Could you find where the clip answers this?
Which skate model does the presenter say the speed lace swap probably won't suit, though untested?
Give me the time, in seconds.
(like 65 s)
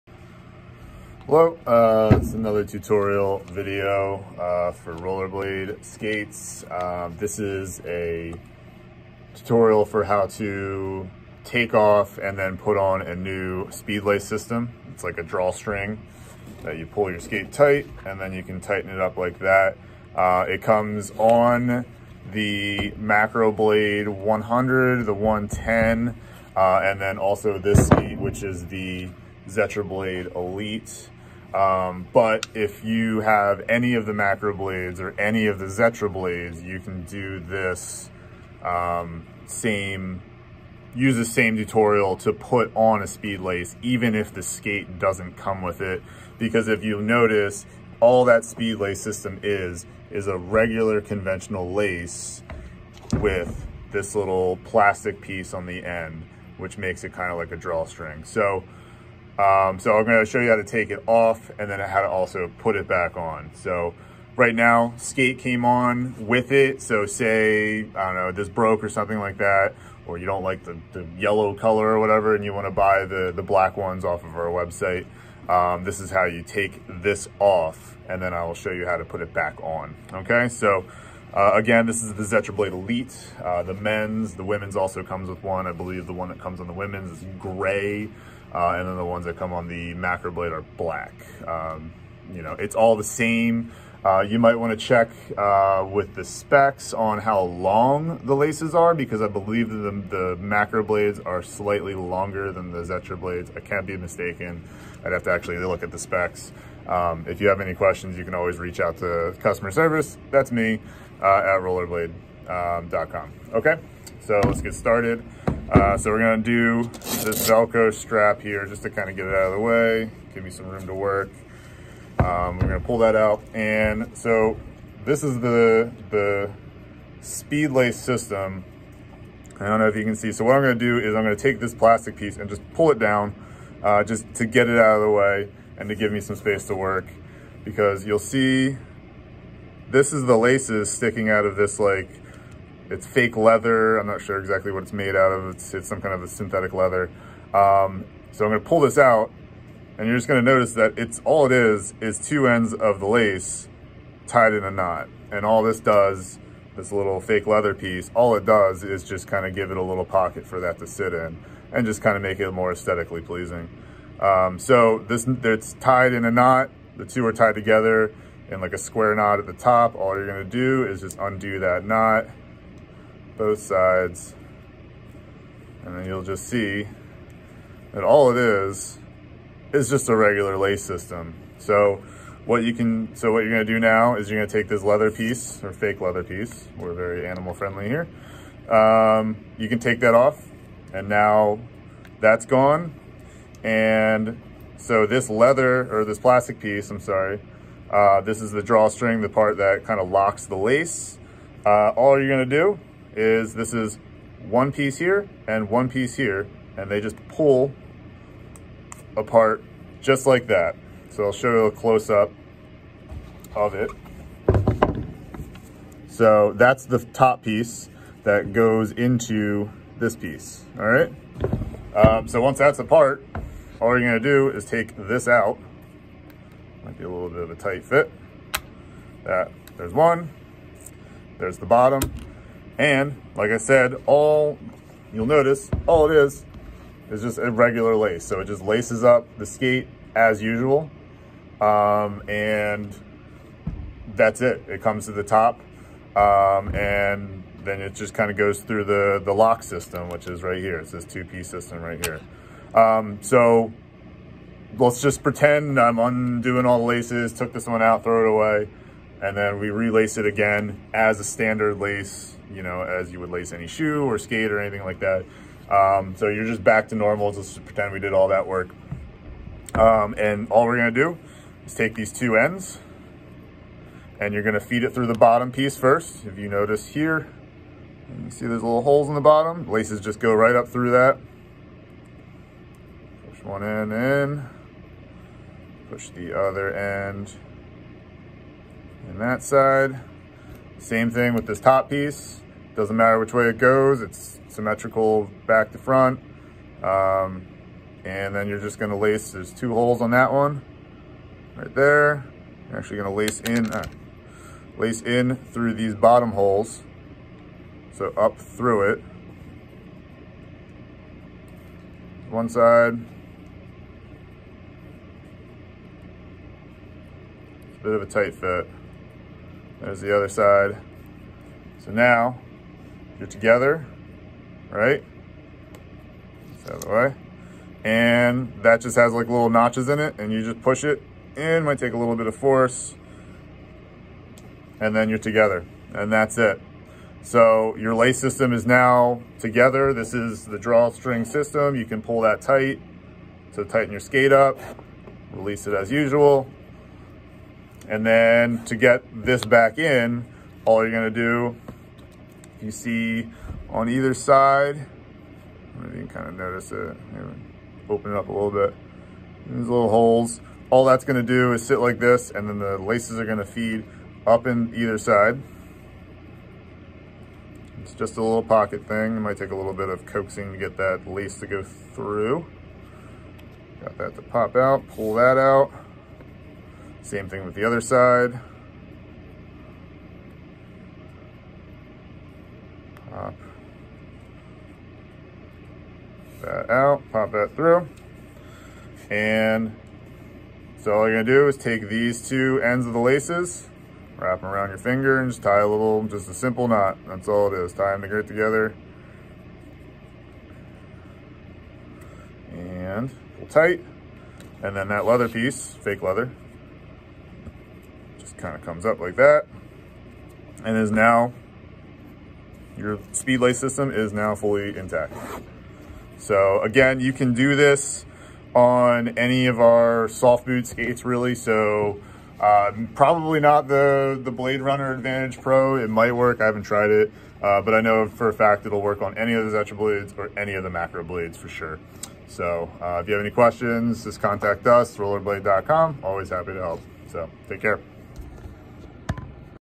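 424 s.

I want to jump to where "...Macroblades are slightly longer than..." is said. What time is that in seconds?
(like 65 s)
100 s.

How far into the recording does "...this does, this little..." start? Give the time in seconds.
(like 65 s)
155 s.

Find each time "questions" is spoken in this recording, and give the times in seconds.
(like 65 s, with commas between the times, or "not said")
107 s, 433 s.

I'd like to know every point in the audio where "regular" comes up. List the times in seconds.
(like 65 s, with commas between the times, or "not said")
50 s, 180 s, 237 s.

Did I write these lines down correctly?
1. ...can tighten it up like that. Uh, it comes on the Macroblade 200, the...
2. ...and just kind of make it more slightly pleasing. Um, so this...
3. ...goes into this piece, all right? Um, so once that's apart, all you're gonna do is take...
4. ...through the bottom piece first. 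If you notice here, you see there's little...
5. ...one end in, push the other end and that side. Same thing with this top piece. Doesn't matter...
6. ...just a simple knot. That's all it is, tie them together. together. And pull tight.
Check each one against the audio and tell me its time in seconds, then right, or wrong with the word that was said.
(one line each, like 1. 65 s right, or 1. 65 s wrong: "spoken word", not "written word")
1. 18 s wrong: "100", not "200"
2. 161 s wrong: "aesthetically", not "slightly"
3. 218 s right
4. 274 s right
5. 283 s right
6. 396 s right.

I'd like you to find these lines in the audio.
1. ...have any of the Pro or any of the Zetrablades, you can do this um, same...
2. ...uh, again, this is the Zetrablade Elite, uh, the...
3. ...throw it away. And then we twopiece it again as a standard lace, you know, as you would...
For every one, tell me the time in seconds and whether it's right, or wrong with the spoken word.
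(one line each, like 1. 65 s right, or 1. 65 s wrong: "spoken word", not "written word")
1. 33 s wrong: "Macroblades", not "Pro"
2. 81 s right
3. 258 s wrong: "relace", not "twopiece".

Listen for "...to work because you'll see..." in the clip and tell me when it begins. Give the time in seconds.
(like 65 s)
136 s.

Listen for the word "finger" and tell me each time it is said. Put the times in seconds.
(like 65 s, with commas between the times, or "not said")
394 s.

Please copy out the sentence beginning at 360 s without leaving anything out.
All that's gonna do is sit like this and then the laces are gonna feed up in either side.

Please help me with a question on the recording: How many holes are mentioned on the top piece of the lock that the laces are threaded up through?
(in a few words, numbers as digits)
2.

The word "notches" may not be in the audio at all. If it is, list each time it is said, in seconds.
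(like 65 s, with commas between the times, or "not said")
329 s.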